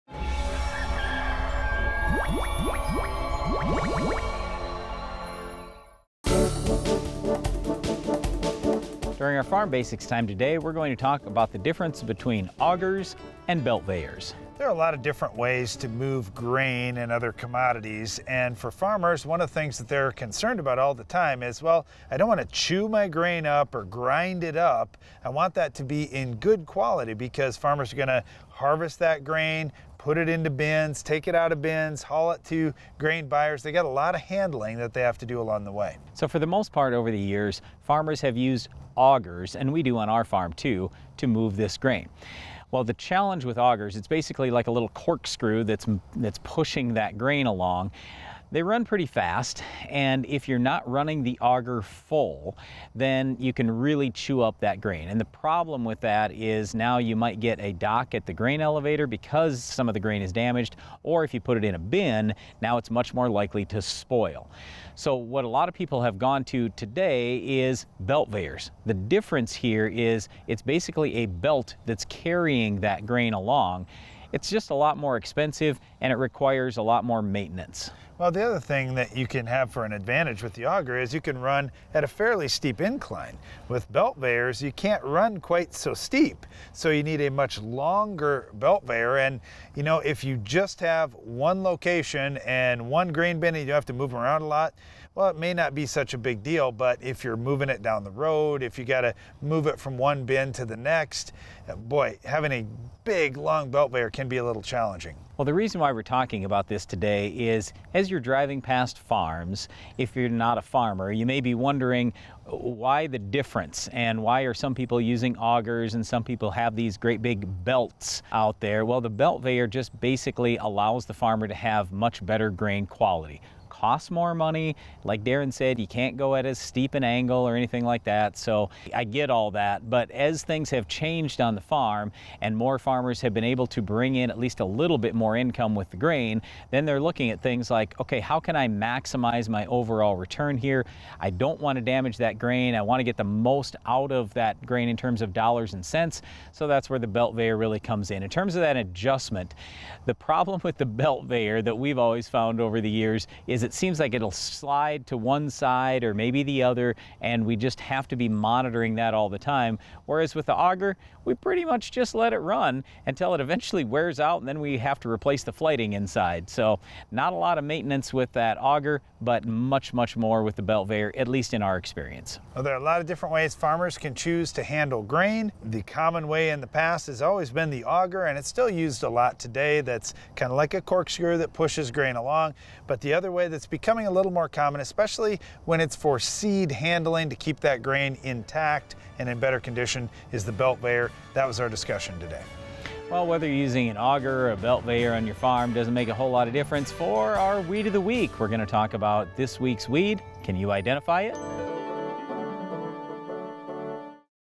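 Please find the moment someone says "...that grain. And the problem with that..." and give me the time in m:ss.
0:54.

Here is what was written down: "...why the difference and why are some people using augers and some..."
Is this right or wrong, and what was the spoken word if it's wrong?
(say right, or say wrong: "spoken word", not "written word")
right.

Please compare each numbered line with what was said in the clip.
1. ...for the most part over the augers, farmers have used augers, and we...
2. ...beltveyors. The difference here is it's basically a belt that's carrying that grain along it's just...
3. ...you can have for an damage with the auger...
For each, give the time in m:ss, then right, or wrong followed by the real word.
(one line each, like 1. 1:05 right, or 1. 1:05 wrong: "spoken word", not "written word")
1. 0:36 wrong: "years", not "augers"
2. 1:08 right
3. 1:19 wrong: "advantage", not "damage".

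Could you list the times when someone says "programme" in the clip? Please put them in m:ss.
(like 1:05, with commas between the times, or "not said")
not said.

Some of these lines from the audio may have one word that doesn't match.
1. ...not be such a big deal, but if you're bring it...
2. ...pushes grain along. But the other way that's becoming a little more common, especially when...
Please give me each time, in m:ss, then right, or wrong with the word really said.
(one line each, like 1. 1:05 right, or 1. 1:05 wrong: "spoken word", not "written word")
1. 1:35 wrong: "moving", not "bring"
2. 3:01 right.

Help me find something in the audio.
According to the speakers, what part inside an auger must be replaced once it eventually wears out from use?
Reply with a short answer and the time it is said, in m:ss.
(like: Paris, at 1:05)
the flighting, at 2:45.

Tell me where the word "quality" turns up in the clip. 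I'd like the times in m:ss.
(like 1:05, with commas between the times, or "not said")
0:26, 2:02.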